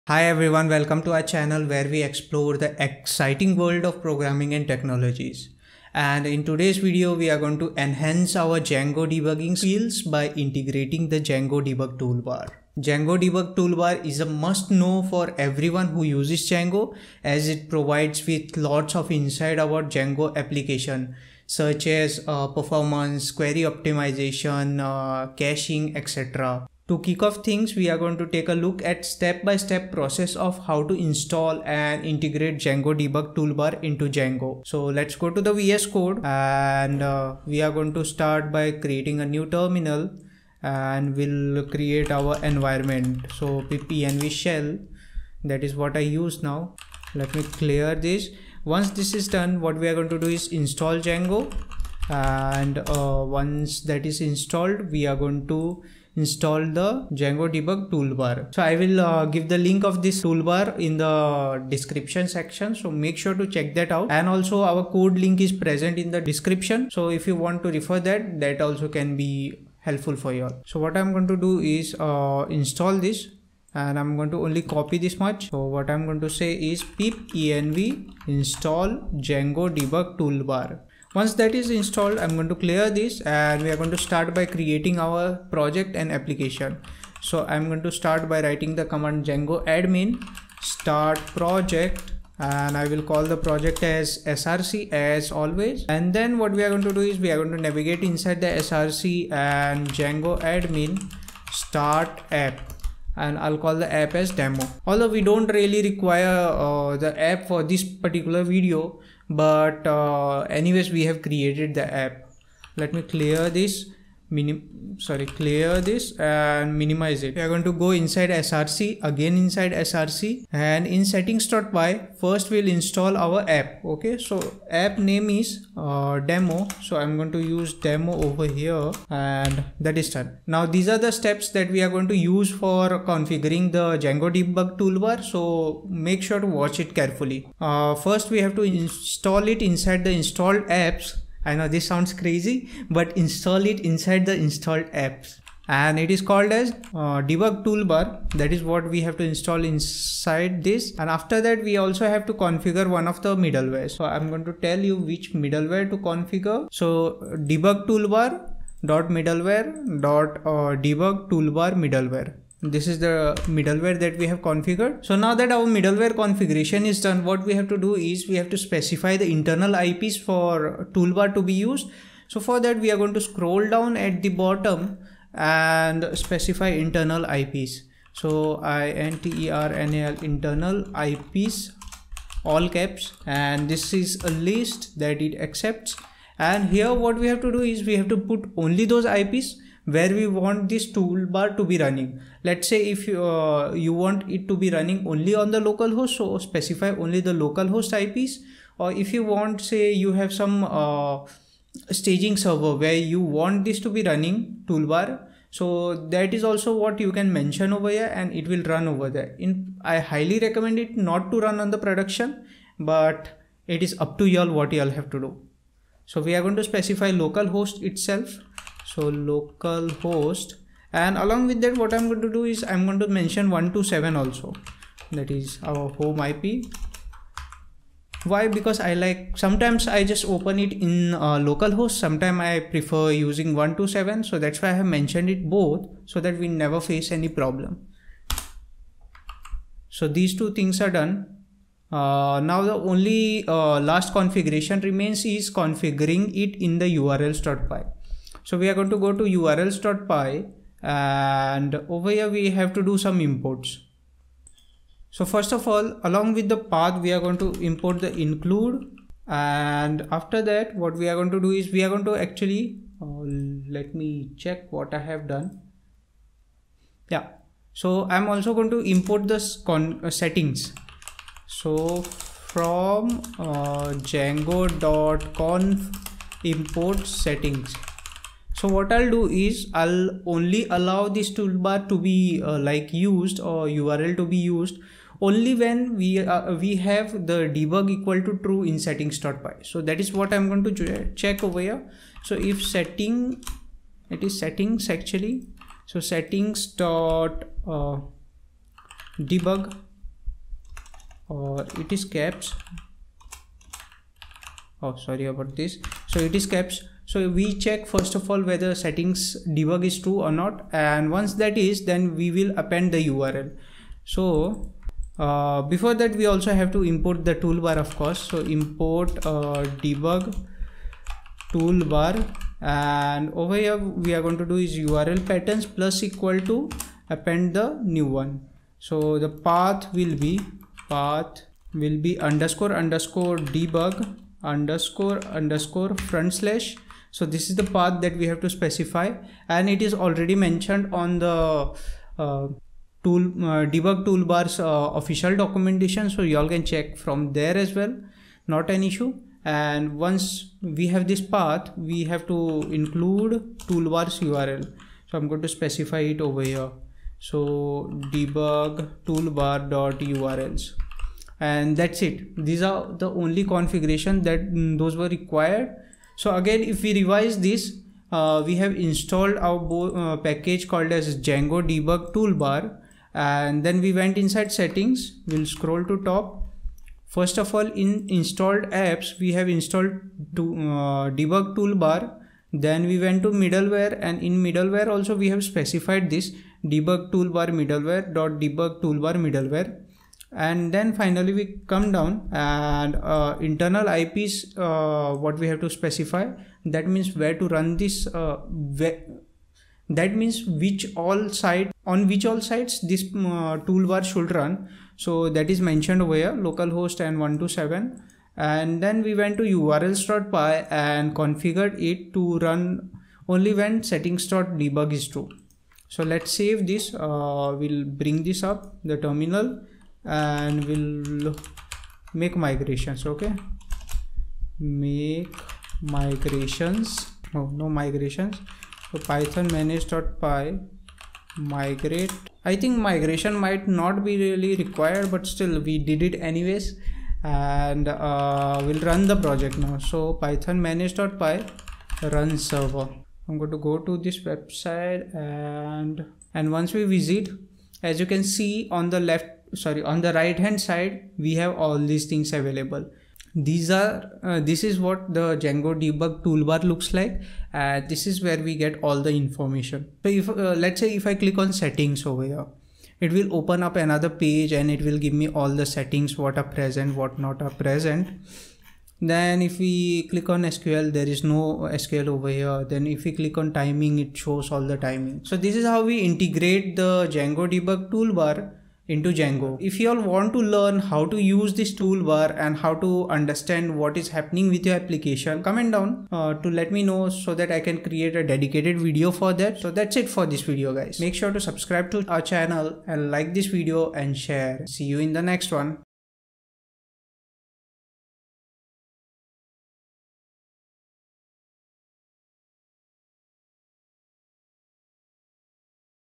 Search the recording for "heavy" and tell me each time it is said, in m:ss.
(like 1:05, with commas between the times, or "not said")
not said.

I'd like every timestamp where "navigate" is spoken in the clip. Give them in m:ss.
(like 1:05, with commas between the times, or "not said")
1:37.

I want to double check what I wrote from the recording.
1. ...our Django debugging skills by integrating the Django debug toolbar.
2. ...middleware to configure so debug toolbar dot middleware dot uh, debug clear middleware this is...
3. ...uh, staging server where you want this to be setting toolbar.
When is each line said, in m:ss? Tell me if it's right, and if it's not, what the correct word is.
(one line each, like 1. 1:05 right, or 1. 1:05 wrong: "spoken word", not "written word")
1. 0:08 right
2. 2:35 wrong: "toolbar", not "clear"
3. 3:20 wrong: "running", not "setting".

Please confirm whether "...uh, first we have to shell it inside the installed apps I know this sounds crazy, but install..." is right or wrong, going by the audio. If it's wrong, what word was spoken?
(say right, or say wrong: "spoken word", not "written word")
wrong: "install", not "shell".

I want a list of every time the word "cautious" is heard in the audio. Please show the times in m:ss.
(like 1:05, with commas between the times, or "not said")
not said.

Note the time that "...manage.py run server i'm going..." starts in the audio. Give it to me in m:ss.
7:20.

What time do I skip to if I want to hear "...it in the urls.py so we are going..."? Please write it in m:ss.
4:06.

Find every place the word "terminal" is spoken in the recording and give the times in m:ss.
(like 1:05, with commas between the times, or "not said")
0:39, 6:58.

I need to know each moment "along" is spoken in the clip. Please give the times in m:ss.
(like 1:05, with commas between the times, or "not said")
3:41, 4:16.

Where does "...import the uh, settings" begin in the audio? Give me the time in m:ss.
4:28.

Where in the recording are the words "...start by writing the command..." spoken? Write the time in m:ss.
1:27.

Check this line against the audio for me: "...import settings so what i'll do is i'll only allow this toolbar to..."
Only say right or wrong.
right.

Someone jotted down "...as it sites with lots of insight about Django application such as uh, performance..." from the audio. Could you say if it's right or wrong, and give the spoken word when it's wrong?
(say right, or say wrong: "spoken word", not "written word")
wrong: "provides", not "sites".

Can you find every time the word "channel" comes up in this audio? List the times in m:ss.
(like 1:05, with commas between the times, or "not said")
0:01, 8:12.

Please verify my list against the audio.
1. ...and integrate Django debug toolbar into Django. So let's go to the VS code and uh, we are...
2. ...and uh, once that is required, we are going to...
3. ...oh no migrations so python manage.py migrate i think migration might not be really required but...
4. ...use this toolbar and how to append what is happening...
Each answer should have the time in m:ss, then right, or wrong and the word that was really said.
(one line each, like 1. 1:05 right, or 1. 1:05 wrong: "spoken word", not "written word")
1. 0:31 right
2. 0:52 wrong: "installed", not "required"
3. 7:07 right
4. 8:01 wrong: "understand", not "append".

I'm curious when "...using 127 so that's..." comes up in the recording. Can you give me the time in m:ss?
3:53.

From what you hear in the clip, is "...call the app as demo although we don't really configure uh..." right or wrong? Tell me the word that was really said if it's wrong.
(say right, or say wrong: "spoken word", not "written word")
wrong: "require", not "configure".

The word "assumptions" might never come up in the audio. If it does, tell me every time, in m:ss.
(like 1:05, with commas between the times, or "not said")
not said.